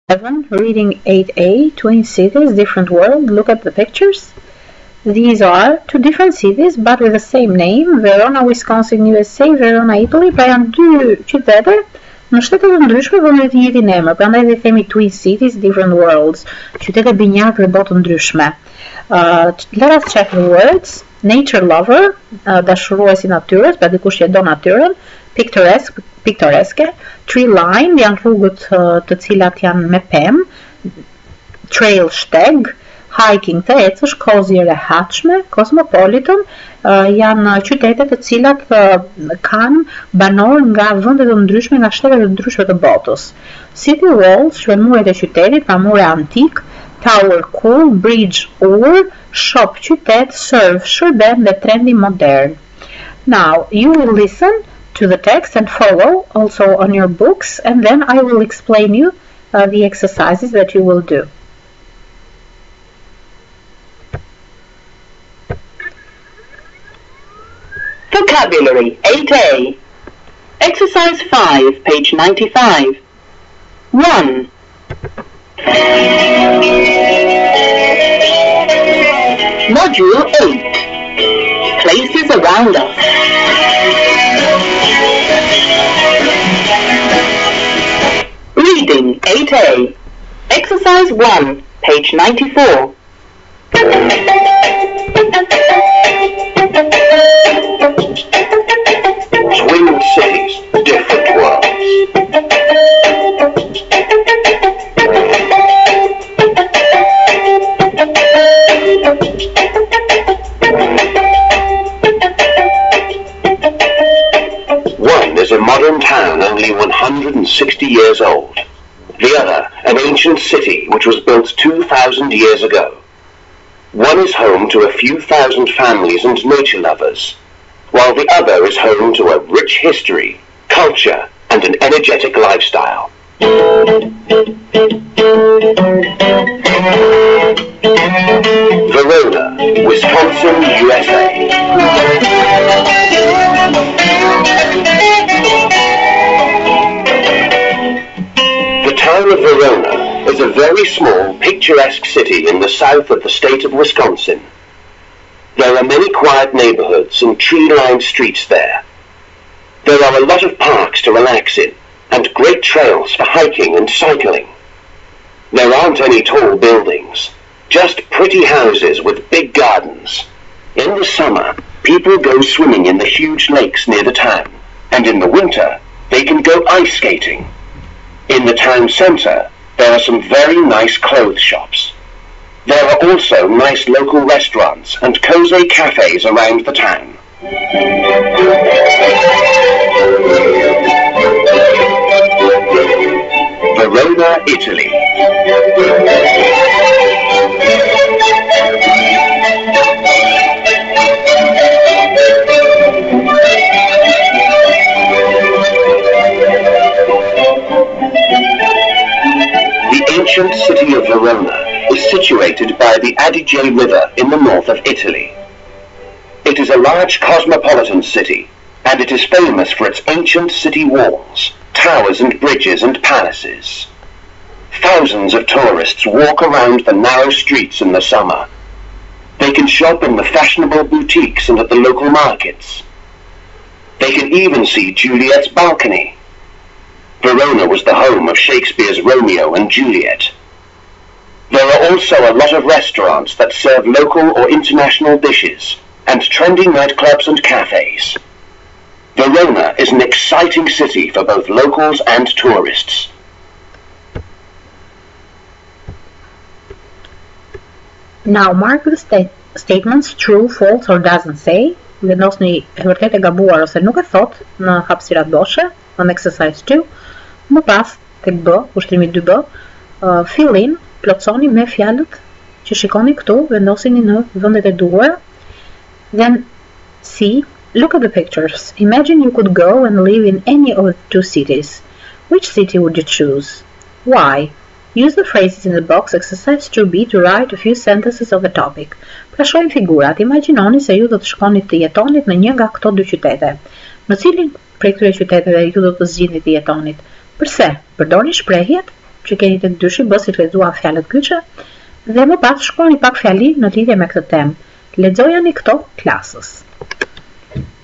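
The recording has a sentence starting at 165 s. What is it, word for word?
There aren't any tall buildings, just pretty houses with big gardens.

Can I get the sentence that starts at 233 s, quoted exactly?
They can even see Juliet's balcony.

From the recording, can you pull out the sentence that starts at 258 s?
Now mark the sta statements true, false or doesn't say.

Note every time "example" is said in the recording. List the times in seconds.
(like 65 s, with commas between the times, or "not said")
not said.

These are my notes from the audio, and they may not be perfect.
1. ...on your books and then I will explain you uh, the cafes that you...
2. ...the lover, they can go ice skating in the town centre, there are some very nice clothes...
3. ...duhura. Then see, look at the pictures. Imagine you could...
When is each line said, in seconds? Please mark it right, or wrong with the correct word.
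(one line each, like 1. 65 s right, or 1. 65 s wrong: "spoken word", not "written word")
1. 56 s wrong: "exercises", not "cafes"
2. 175 s wrong: "winter", not "lover"
3. 274 s right.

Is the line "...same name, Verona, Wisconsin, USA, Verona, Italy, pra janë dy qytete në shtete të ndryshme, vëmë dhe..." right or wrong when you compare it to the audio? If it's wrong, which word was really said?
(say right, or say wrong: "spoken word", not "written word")
right.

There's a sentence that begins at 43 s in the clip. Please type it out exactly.
City walls, shremurit e qytetit, pamure antik, tower cool, bridge ur, shop qytet, surf, shërben dhe trendi modern.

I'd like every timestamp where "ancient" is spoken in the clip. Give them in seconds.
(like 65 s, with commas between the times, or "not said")
119 s, 220 s.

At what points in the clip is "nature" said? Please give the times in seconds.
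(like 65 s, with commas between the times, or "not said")
21 s, 126 s.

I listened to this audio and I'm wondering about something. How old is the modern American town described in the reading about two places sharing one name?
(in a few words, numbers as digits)
160 years.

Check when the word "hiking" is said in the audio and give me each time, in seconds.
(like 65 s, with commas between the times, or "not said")
33 s, 163 s.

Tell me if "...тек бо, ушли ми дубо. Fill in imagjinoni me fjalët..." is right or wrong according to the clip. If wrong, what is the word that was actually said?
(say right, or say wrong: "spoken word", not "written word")
wrong: "plotësoni", not "imagjinoni".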